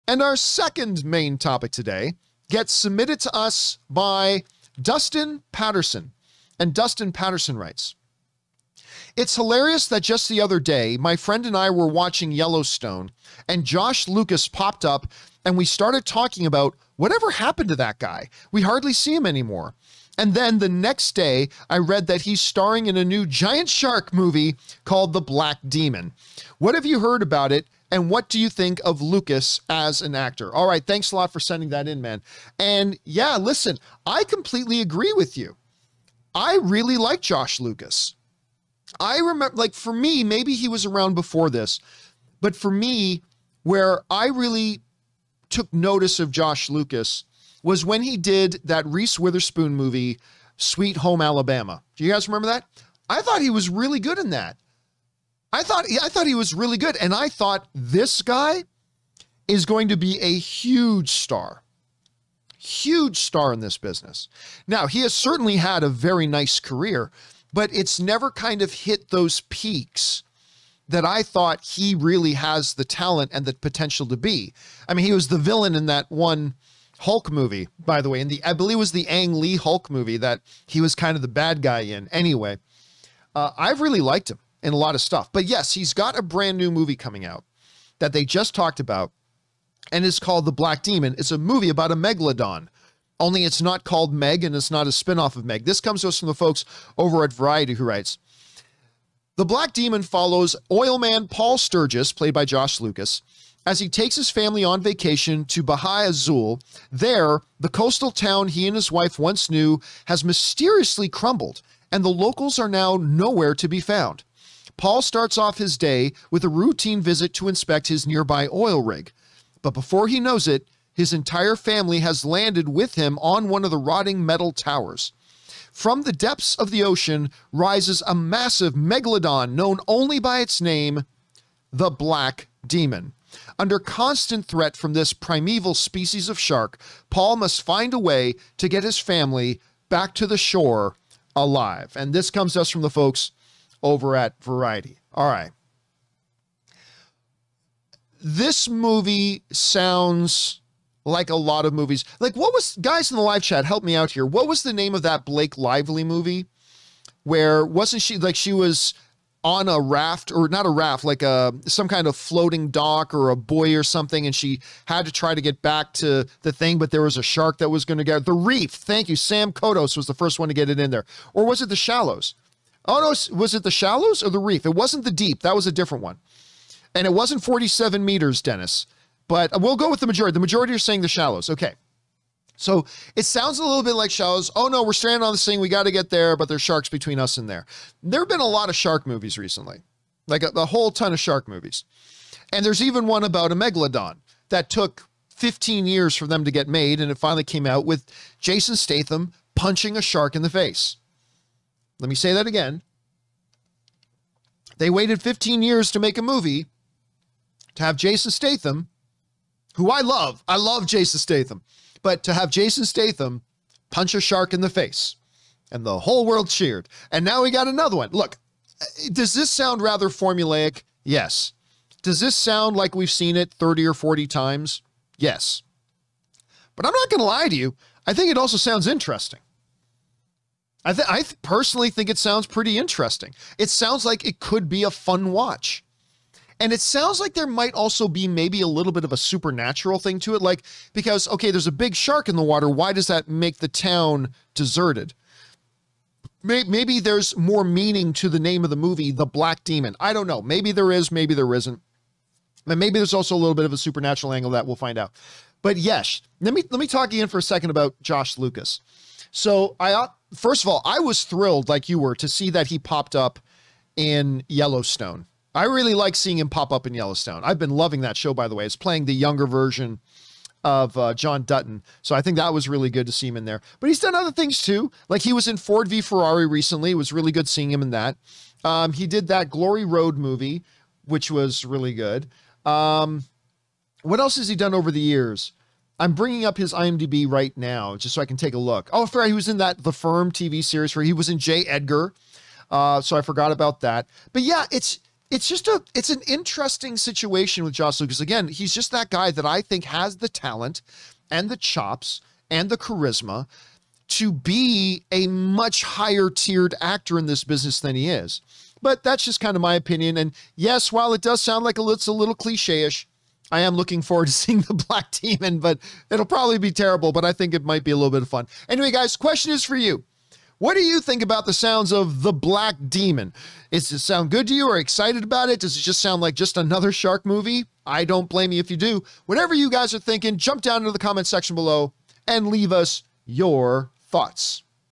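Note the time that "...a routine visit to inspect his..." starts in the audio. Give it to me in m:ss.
1:56.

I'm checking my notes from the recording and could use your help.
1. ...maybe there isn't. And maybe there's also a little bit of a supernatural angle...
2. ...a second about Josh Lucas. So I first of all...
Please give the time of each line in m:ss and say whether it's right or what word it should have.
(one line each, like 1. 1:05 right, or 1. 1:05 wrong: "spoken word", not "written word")
1. 4:11 right
2. 4:17 right.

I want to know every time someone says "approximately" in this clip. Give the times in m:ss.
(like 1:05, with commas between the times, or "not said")
not said.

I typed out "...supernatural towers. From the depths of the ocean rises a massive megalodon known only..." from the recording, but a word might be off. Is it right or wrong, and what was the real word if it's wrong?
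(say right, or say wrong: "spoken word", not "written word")
wrong: "metal", not "supernatural".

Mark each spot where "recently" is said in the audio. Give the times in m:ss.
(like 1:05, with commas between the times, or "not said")
3:09, 4:36.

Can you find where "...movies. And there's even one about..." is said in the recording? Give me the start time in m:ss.
3:11.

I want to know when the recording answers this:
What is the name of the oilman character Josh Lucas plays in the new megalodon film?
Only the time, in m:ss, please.
1:41.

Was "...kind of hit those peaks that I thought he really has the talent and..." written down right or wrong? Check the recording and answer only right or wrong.
right.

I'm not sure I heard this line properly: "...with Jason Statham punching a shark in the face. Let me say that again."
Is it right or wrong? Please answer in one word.
right.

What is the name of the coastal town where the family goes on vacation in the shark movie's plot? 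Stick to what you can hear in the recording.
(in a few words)
Bahia Azul.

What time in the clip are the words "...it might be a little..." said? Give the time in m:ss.
5:17.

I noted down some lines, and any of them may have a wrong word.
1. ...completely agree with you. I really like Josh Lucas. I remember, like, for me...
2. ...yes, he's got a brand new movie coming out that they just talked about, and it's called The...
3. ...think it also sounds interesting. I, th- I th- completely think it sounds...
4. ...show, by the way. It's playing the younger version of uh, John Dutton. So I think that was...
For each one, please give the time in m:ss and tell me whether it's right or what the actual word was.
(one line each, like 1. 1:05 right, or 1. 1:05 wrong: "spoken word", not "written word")
1. 0:34 right
2. 1:25 right
3. 3:48 wrong: "personally", not "completely"
4. 4:28 right.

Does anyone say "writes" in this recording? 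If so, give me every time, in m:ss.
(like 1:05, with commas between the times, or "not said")
0:07, 1:37.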